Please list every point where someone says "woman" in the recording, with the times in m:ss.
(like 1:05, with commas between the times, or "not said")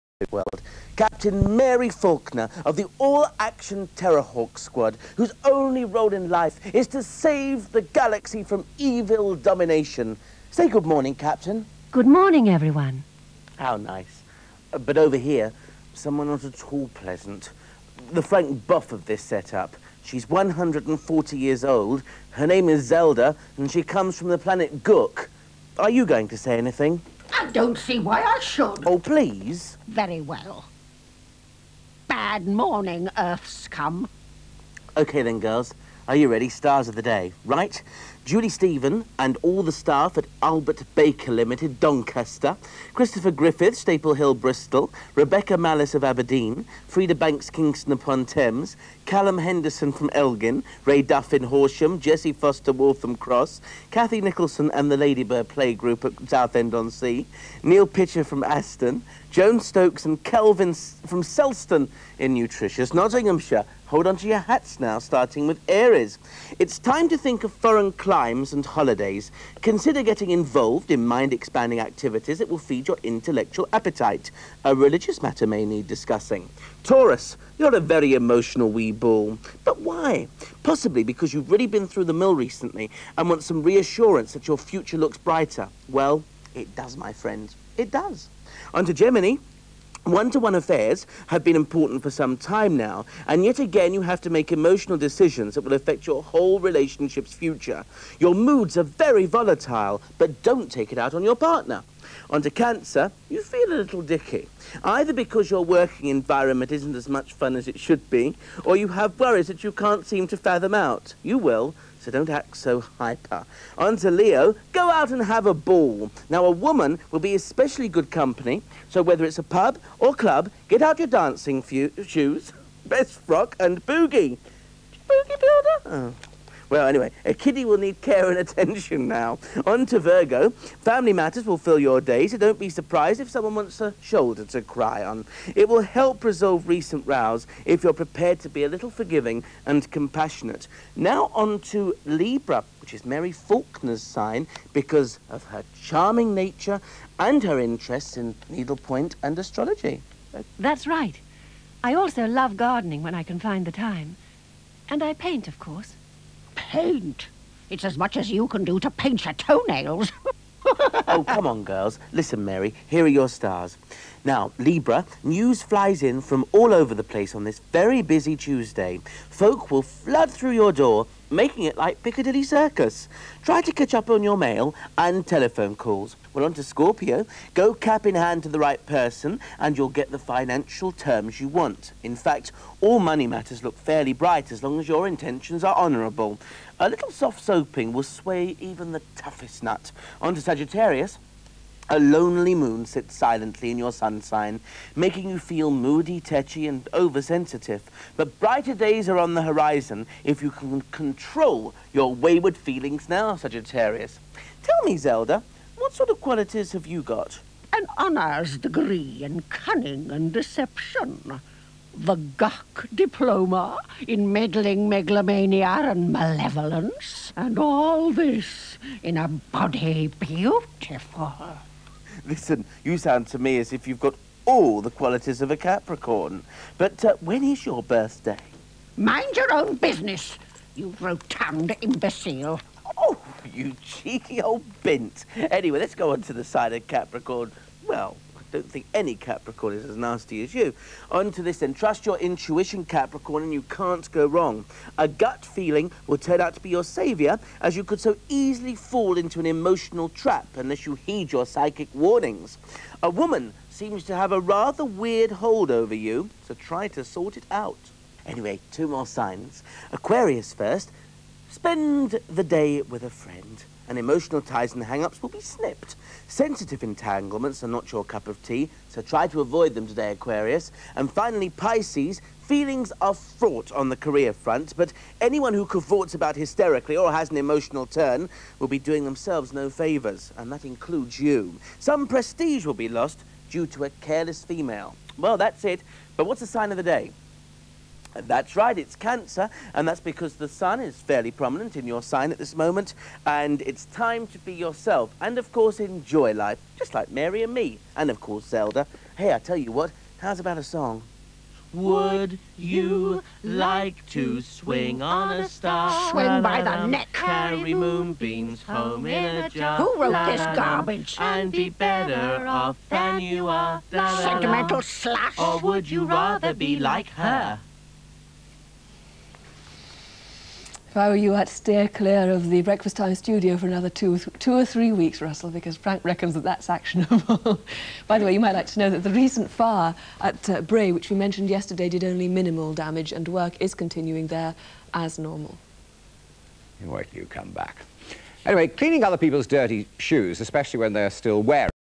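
1:56, 4:13.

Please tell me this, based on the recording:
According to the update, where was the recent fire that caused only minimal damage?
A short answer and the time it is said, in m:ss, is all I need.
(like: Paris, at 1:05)
Bray, at 5:30.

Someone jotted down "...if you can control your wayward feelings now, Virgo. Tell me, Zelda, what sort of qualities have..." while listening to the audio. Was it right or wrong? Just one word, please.
wrong.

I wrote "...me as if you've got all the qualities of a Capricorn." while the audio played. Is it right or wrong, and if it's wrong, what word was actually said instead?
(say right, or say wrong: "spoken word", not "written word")
right.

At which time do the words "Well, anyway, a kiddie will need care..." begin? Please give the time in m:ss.
2:06.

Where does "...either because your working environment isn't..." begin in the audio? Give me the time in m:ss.
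1:44.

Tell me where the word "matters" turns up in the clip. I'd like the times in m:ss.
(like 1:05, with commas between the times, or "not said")
1:15, 2:11, 3:03.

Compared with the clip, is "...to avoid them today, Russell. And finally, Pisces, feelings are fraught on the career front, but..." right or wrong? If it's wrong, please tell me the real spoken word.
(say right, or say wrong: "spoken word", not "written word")
wrong: "Aquarius", not "Russell".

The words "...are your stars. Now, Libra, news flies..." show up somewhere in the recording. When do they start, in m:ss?
2:43.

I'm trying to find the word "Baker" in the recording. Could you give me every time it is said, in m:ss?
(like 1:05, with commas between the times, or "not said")
0:40.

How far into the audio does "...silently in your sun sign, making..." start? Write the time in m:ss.
3:13.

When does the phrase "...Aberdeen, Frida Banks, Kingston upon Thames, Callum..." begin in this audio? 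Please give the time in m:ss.
0:46.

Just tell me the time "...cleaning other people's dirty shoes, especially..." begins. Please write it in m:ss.
5:38.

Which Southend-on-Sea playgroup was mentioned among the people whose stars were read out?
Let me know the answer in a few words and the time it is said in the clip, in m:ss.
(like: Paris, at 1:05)
Ladybird Playgroup, at 0:54.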